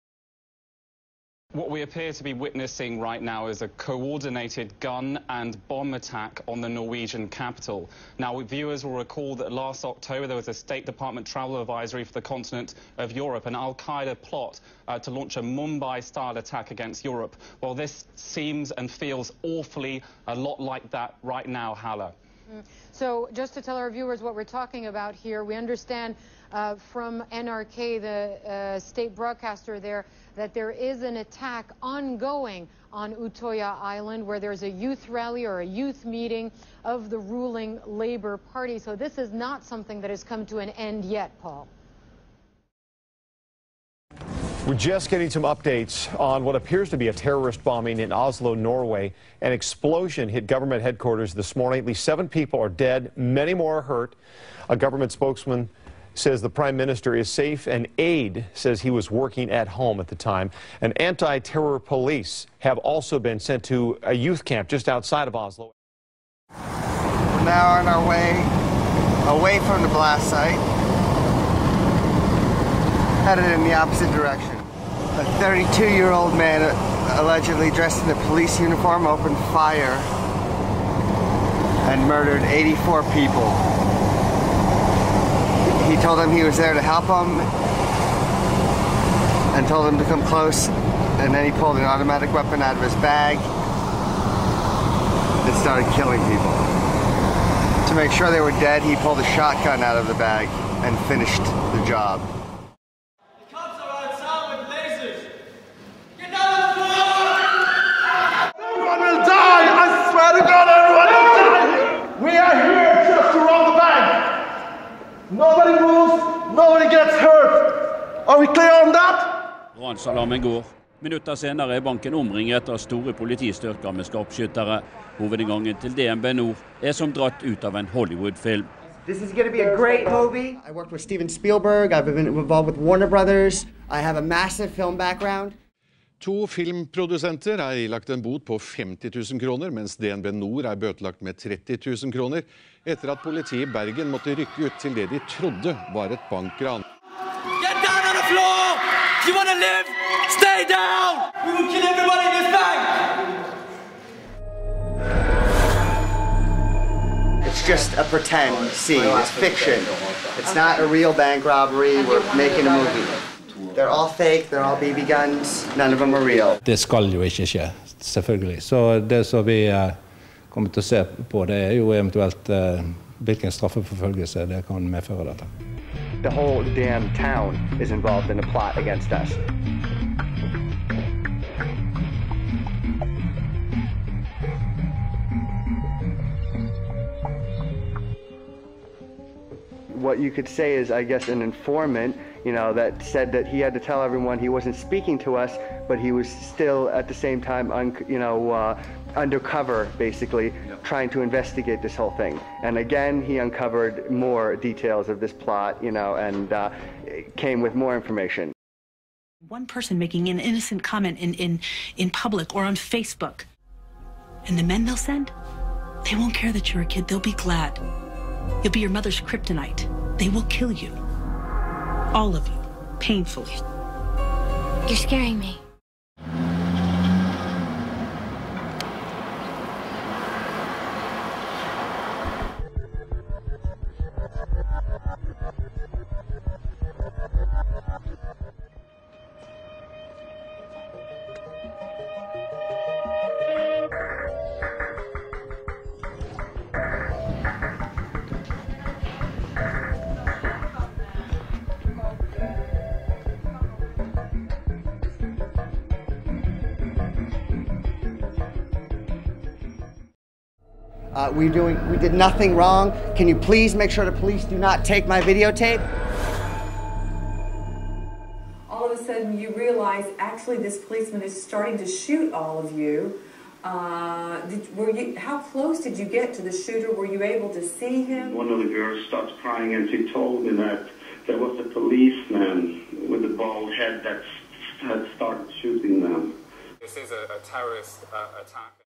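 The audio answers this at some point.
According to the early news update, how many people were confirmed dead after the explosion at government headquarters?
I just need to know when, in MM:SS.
00:52.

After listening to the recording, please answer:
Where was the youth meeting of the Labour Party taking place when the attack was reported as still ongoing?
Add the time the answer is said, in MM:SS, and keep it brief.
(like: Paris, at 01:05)
Utoya Island, at 00:33.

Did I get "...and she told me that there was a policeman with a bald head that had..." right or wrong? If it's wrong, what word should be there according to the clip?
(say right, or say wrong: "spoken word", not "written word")
right.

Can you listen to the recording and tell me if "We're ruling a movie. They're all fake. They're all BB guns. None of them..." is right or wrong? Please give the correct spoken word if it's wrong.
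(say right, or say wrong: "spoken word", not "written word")
wrong: "making", not "ruling".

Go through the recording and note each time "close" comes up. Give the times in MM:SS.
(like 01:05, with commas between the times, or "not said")
01:30, 04:35.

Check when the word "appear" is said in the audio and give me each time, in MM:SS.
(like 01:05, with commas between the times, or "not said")
00:01, 00:46.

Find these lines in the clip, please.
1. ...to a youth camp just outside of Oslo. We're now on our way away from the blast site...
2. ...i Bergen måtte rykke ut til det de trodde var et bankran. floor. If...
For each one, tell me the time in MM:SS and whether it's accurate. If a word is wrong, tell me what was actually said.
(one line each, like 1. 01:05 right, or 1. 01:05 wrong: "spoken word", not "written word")
1. 01:03 right
2. 02:23 right.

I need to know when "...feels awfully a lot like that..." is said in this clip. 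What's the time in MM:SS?
00:18.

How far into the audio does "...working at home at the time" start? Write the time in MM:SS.
00:59.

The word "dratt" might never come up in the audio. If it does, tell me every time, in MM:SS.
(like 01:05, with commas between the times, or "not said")
02:07.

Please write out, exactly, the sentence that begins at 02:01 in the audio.
Minutter senere er banken omringet av store politistyrker med skarpskyttere.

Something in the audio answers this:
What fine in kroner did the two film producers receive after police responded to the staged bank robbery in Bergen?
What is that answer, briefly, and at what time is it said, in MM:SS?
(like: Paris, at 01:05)
50,000 kroner, at 02:18.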